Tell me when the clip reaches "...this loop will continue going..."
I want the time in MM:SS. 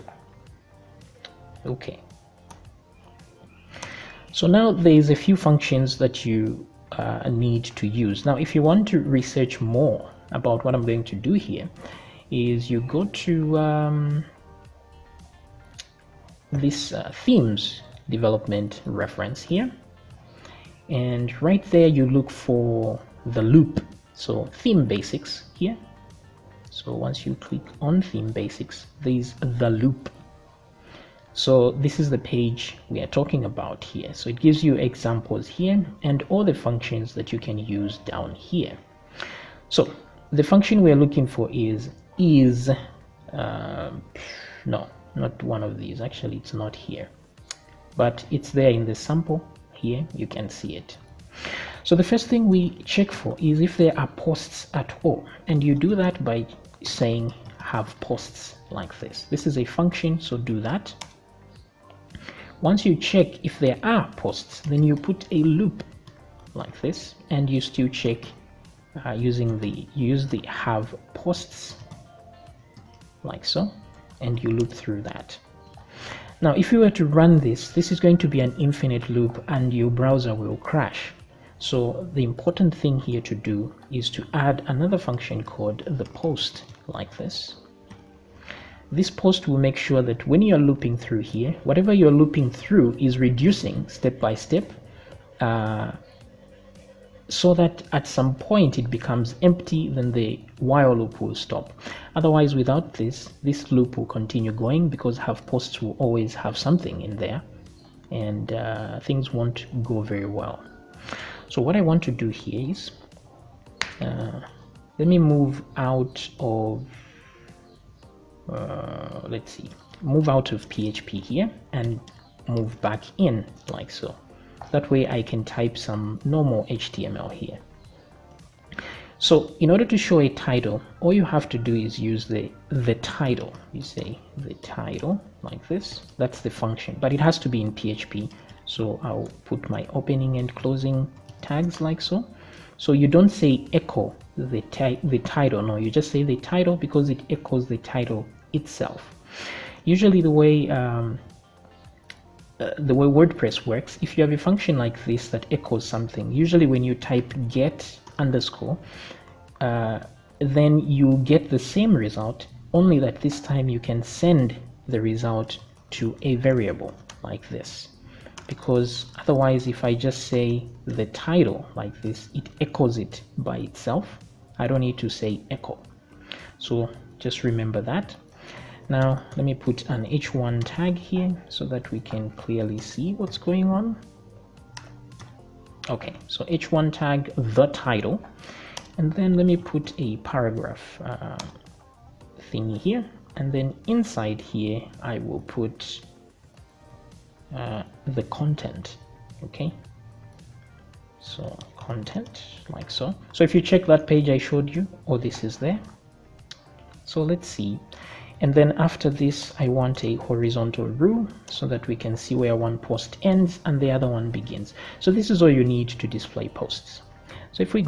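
01:43.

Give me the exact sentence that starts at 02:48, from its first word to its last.
Because otherwise, if I just say the title like this, it echoes it by itself.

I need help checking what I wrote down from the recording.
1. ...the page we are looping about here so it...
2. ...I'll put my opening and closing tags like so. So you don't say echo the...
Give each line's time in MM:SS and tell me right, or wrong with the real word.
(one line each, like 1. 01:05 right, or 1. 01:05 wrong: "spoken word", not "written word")
1. 00:32 wrong: "talking", not "looping"
2. 02:19 right.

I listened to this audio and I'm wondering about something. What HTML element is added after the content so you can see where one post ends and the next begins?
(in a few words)
horizontal rule.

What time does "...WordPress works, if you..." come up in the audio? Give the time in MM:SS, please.
02:33.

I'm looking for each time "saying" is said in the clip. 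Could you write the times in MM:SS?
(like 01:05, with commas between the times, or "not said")
00:56.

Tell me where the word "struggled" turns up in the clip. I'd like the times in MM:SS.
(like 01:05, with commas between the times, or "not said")
not said.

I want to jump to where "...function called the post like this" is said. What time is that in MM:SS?
01:24.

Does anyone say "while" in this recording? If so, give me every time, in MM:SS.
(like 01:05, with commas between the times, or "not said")
01:40.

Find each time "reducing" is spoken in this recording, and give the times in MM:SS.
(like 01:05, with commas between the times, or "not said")
01:33.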